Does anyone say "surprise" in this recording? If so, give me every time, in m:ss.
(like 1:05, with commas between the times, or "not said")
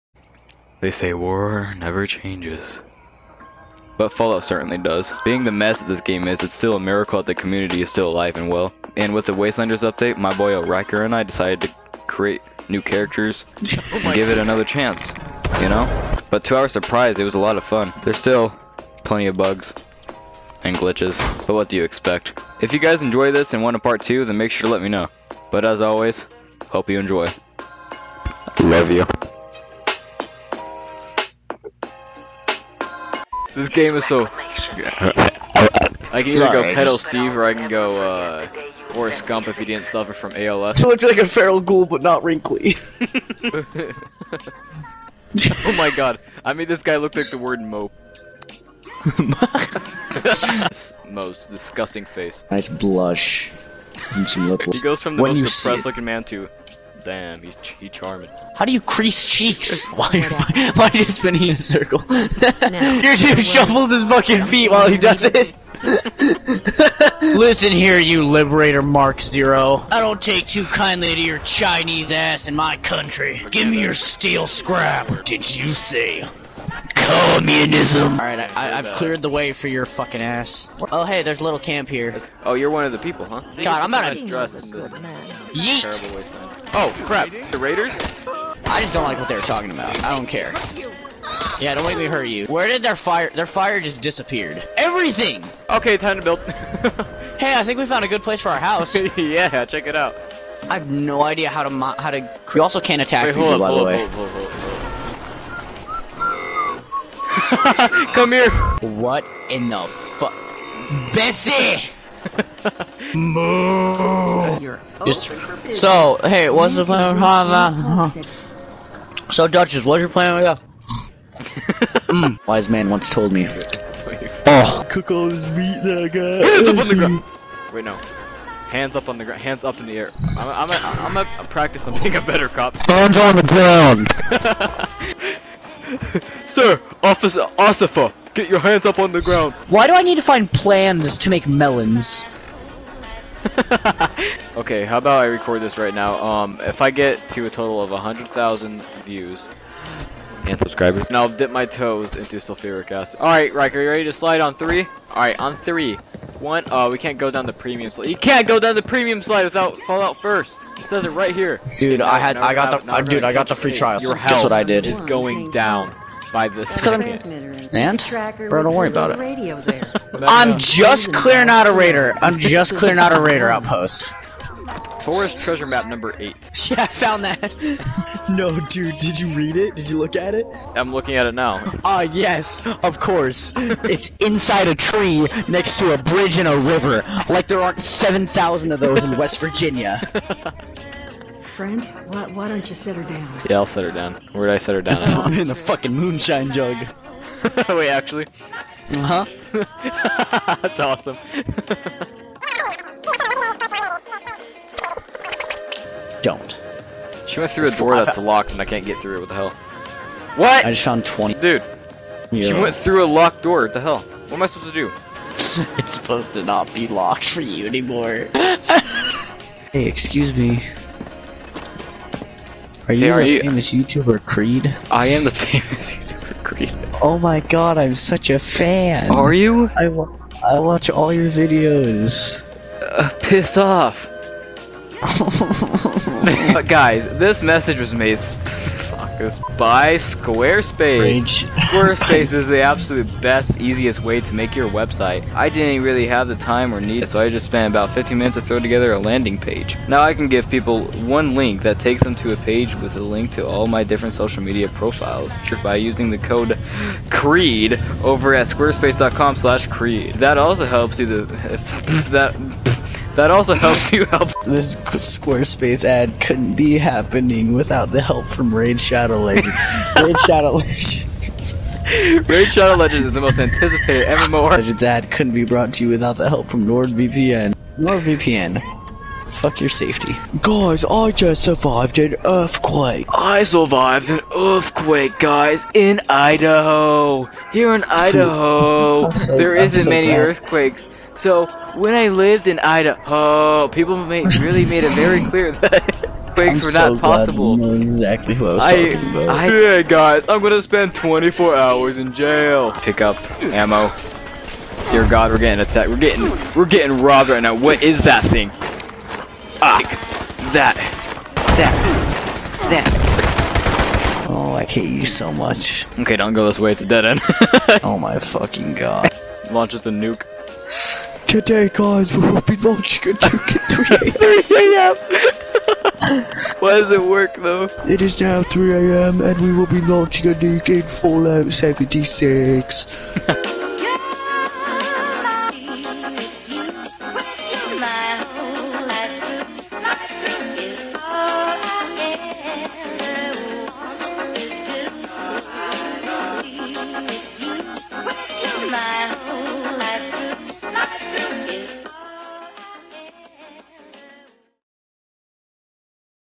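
0:16.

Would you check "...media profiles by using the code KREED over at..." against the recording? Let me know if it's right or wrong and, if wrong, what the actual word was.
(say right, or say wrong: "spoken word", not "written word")
right.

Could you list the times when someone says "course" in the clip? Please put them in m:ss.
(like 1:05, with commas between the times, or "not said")
3:02.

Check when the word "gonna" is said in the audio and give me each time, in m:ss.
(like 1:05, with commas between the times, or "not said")
2:10, 5:00.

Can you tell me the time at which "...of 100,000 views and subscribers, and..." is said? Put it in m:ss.
2:27.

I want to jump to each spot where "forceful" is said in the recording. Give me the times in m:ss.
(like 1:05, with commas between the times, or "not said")
not said.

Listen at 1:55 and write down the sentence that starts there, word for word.
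Just, so, hey, what's the plan?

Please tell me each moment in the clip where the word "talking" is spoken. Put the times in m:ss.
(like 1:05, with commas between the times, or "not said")
1:29, 4:58.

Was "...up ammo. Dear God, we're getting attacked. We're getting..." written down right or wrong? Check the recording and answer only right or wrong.
right.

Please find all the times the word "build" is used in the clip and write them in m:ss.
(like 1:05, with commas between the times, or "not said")
1:36.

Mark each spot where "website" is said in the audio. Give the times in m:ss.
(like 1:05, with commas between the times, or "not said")
4:04.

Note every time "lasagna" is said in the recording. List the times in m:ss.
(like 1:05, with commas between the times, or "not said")
not said.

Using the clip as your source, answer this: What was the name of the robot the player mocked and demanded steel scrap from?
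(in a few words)
Liberator Mark Zero.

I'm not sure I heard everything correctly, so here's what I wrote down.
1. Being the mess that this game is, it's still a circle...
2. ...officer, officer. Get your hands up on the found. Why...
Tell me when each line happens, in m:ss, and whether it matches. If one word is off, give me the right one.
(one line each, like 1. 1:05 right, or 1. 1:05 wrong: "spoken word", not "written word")
1. 0:05 wrong: "miracle", not "circle"
2. 2:17 wrong: "ground", not "found".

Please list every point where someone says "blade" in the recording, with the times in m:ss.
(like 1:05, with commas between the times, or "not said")
not said.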